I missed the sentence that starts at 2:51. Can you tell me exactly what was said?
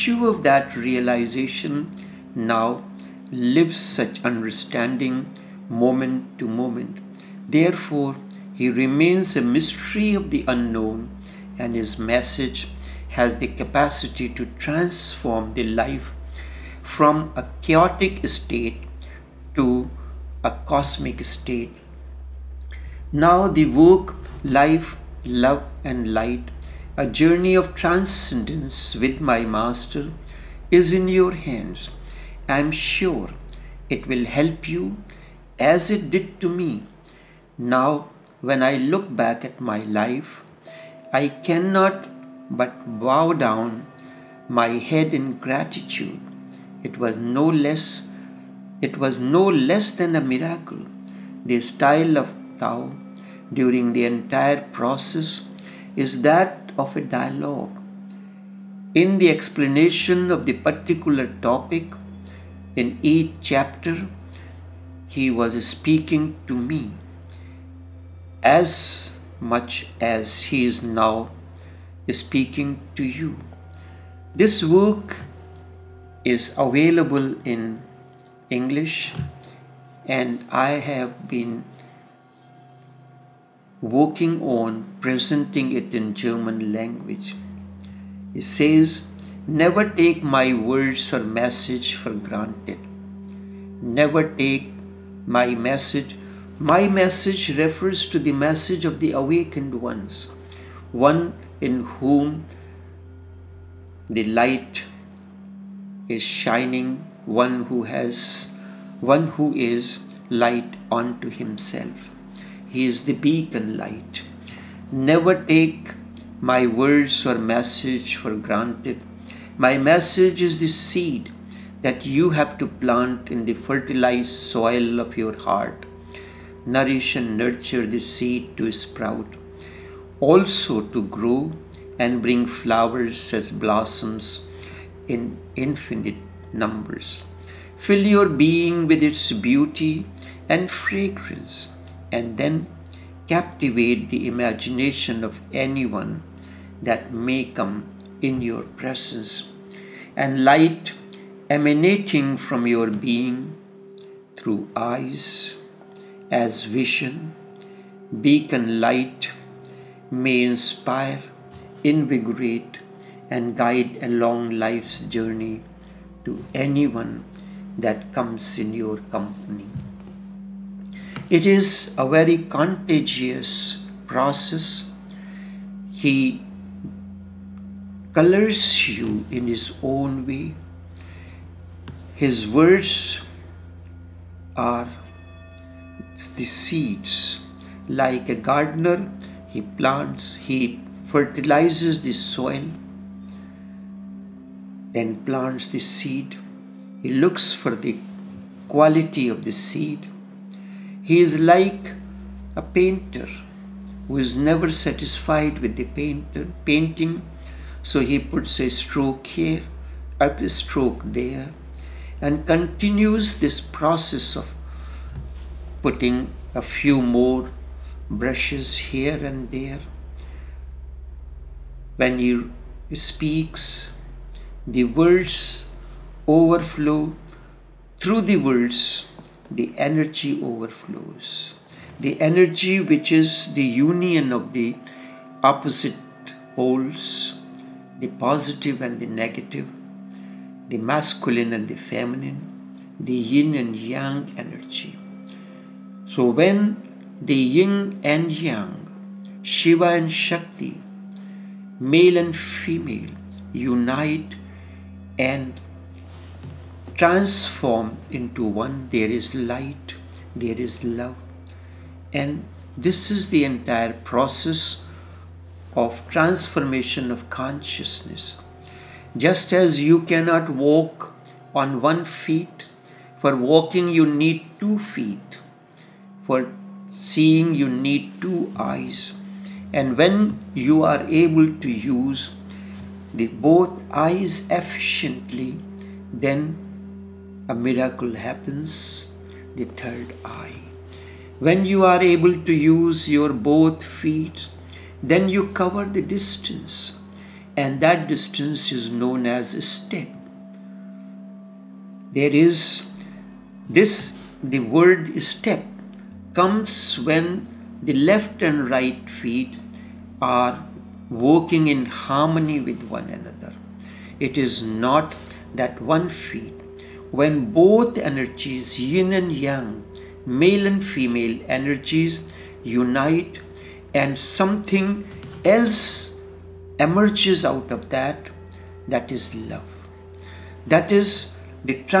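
It is a very contagious process.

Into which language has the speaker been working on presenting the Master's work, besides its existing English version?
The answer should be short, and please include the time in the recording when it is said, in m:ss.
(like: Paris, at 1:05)
German, at 1:26.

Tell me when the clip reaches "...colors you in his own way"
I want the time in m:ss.
2:58.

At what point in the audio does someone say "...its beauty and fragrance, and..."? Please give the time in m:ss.
2:19.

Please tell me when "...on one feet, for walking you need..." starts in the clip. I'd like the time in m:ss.
4:31.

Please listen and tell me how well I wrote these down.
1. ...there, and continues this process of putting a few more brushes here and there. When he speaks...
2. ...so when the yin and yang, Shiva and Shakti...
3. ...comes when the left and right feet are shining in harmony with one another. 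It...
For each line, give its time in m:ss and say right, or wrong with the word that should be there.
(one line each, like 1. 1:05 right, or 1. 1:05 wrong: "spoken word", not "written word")
1. 3:31 right
2. 4:06 right
3. 5:06 wrong: "working", not "shining".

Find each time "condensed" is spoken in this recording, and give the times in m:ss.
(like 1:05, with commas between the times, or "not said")
not said.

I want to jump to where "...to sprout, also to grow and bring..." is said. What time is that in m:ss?
2:08.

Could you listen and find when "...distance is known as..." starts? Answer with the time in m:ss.
4:58.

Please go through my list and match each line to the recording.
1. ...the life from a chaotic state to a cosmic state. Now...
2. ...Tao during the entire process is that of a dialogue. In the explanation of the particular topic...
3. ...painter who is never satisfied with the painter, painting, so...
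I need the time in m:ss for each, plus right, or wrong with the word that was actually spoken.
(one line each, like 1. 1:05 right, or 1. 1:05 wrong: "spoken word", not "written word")
1. 0:15 right
2. 0:52 right
3. 3:22 right.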